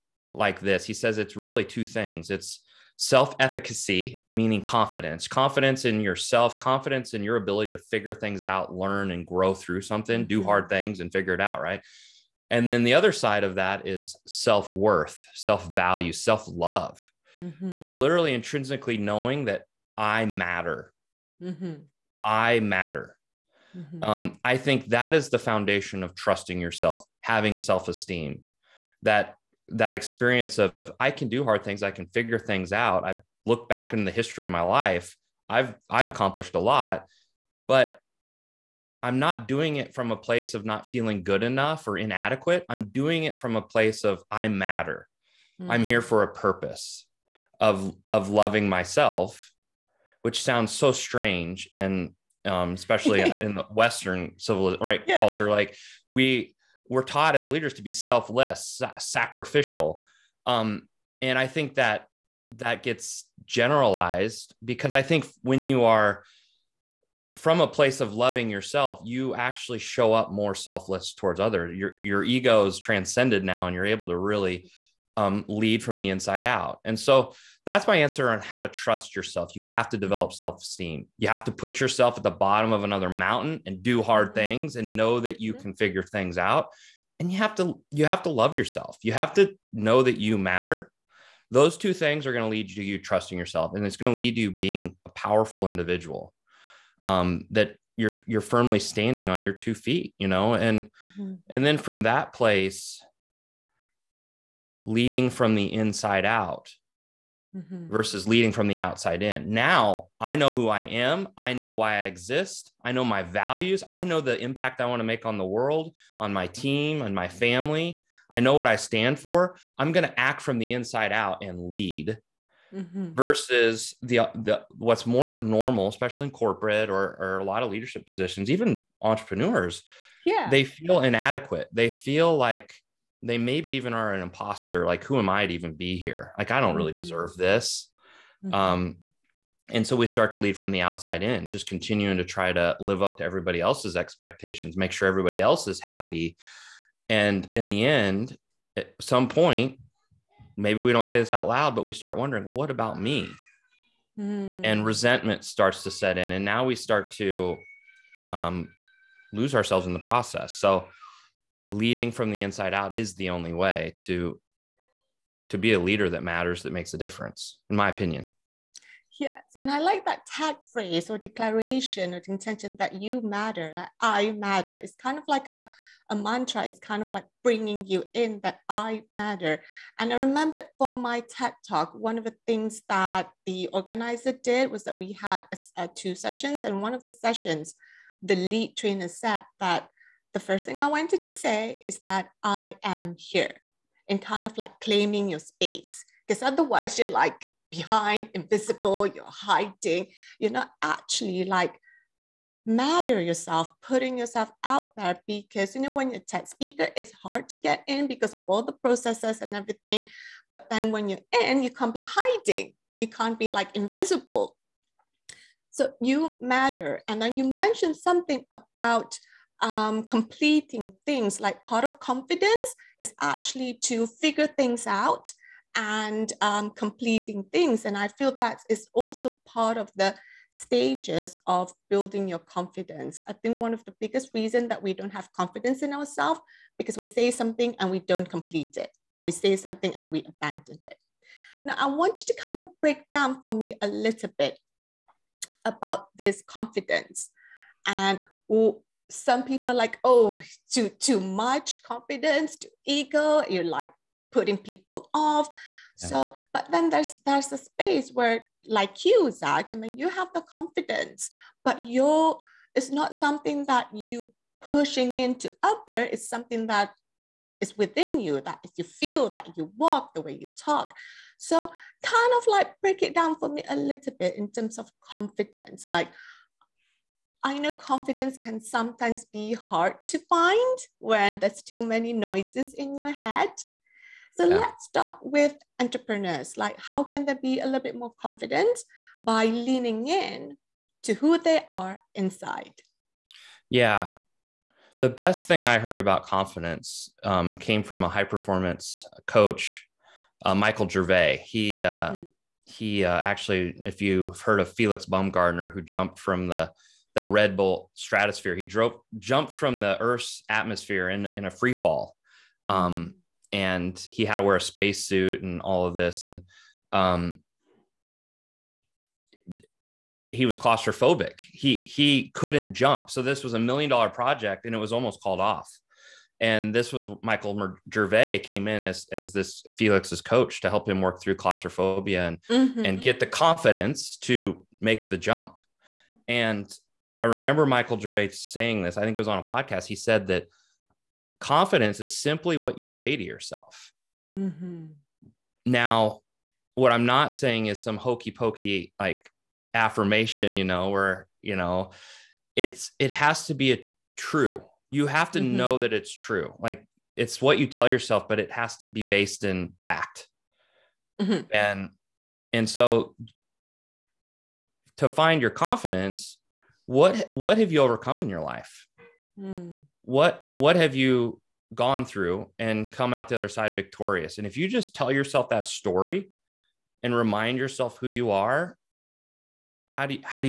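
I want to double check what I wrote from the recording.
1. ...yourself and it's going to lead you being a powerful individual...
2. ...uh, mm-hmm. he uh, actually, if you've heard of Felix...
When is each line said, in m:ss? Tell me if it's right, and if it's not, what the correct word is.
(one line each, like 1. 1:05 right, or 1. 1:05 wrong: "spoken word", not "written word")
1. 1:33 right
2. 5:01 right.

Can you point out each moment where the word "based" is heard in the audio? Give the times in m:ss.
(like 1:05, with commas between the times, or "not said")
5:59.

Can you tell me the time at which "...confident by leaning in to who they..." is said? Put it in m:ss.
4:48.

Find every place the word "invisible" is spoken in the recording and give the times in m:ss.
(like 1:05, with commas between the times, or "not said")
3:18, 3:33.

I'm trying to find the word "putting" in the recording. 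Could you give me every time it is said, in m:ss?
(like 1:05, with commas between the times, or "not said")
3:23, 4:14.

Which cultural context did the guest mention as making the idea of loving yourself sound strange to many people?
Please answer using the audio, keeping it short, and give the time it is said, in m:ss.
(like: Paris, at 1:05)
Western, at 0:53.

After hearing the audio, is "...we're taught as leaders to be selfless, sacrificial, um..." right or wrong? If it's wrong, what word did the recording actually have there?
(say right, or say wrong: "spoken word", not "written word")
right.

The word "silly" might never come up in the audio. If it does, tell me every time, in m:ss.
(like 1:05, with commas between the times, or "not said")
not said.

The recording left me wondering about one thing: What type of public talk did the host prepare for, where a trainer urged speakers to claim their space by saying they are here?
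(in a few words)
TED talk.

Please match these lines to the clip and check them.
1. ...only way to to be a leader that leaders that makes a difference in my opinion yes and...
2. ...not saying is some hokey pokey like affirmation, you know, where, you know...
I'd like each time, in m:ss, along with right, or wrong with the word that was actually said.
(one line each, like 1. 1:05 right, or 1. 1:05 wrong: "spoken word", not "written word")
1. 2:43 wrong: "matters", not "leaders"
2. 5:47 right.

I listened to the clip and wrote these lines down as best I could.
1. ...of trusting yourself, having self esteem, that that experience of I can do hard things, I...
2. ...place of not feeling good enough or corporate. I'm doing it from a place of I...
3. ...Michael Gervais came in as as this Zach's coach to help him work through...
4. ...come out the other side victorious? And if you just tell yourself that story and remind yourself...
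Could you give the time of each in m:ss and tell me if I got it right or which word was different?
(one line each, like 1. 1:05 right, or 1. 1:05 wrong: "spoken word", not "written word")
1. 0:26 right
2. 0:40 wrong: "inadequate", not "corporate"
3. 5:27 wrong: "Felix", not "Zach"
4. 6:12 right.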